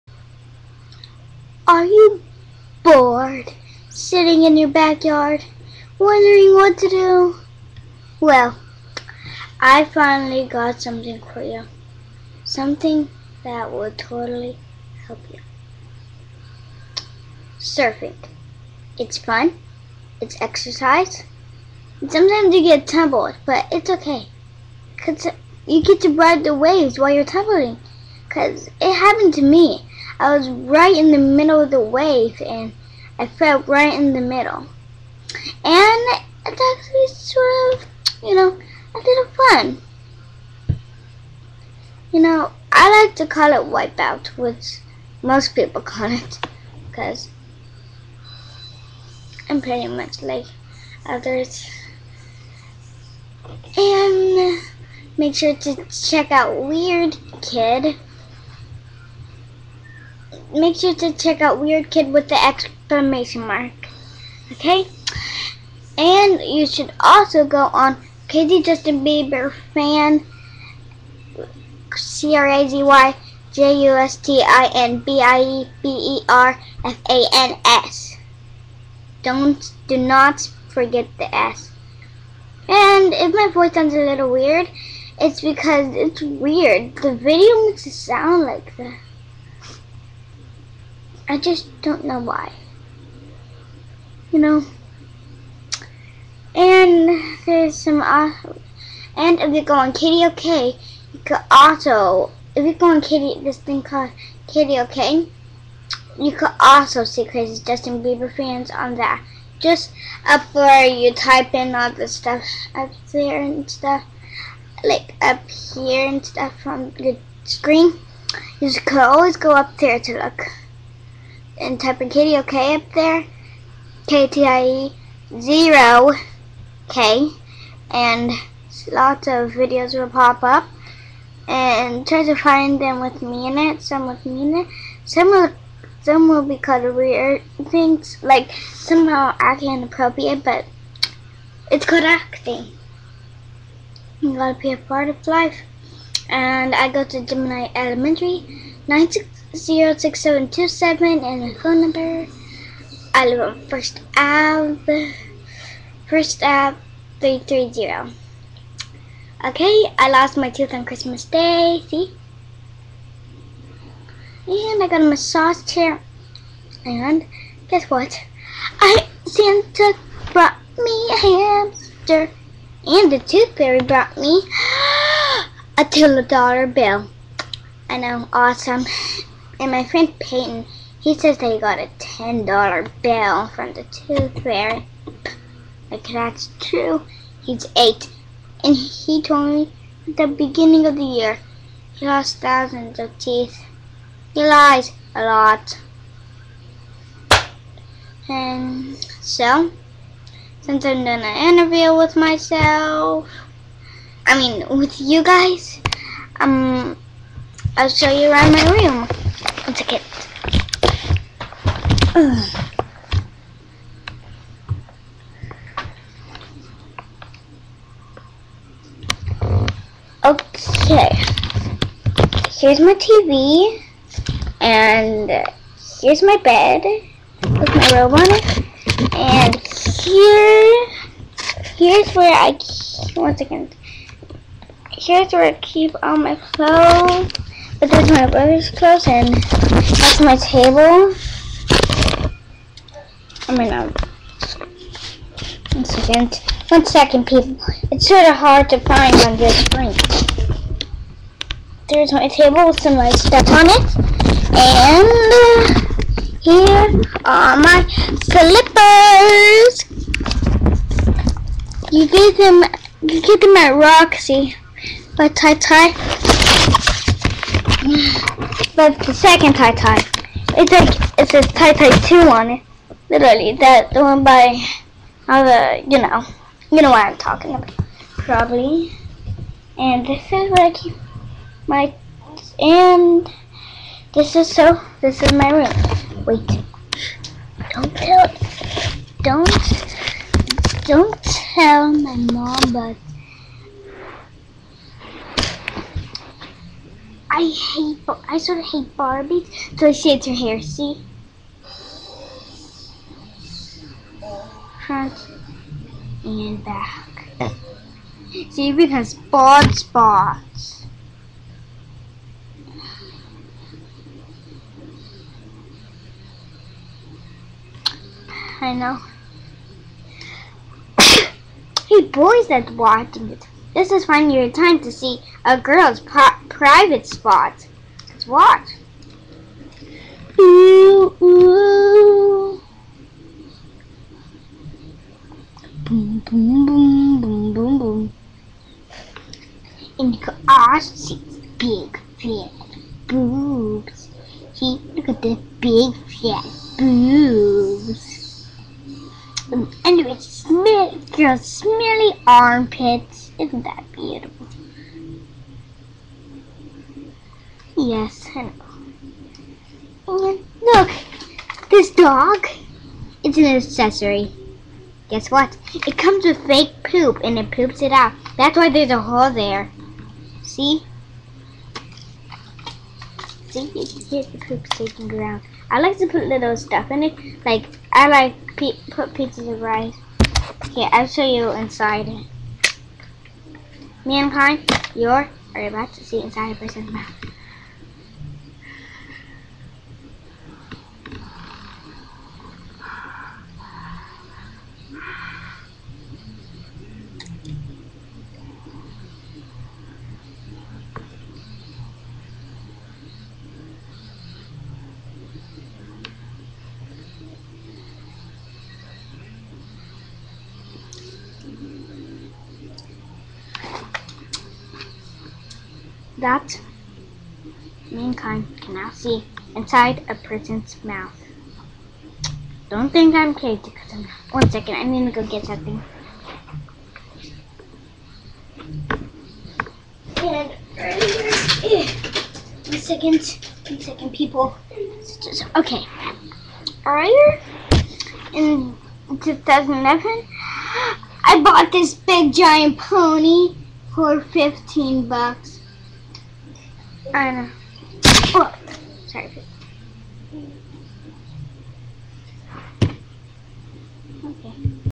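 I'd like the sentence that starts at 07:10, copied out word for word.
And earlier, one second, one second, people.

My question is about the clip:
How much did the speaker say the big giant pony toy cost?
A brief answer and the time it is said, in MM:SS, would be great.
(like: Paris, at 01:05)
15 bucks, at 07:24.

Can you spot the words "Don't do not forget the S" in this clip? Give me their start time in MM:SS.
01:19.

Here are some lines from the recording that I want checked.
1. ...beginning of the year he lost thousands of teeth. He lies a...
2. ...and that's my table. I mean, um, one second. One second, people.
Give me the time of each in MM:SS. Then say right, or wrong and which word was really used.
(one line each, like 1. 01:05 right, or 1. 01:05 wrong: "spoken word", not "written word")
1. 03:10 right
2. 03:59 right.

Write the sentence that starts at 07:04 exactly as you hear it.
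One second, I'm gonna go get something.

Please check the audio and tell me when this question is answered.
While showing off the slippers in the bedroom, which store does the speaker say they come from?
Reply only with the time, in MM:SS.
04:23.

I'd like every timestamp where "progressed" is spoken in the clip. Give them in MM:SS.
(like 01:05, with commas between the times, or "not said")
not said.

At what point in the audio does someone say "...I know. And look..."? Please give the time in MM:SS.
05:58.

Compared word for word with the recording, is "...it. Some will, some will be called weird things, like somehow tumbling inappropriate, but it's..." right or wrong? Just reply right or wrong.
wrong.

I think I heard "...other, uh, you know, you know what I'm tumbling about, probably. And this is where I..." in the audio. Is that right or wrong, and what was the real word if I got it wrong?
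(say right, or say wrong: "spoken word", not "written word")
wrong: "talking", not "tumbling".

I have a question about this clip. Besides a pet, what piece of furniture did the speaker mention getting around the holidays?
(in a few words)
massage chair.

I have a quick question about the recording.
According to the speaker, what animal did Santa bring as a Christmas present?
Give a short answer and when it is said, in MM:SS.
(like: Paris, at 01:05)
hamster, at 02:51.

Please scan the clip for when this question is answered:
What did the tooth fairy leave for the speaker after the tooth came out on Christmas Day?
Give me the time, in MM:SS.
02:55.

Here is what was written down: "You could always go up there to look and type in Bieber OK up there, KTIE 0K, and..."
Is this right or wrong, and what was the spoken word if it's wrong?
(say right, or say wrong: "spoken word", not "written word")
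wrong: "Katie", not "Bieber".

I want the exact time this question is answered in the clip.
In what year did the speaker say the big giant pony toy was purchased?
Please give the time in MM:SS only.
07:19.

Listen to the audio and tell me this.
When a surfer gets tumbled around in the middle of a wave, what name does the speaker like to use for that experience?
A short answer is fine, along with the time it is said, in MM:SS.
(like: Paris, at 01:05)
Wipeout, at 00:43.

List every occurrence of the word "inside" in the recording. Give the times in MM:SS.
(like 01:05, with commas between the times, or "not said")
06:21, 06:26, 06:59.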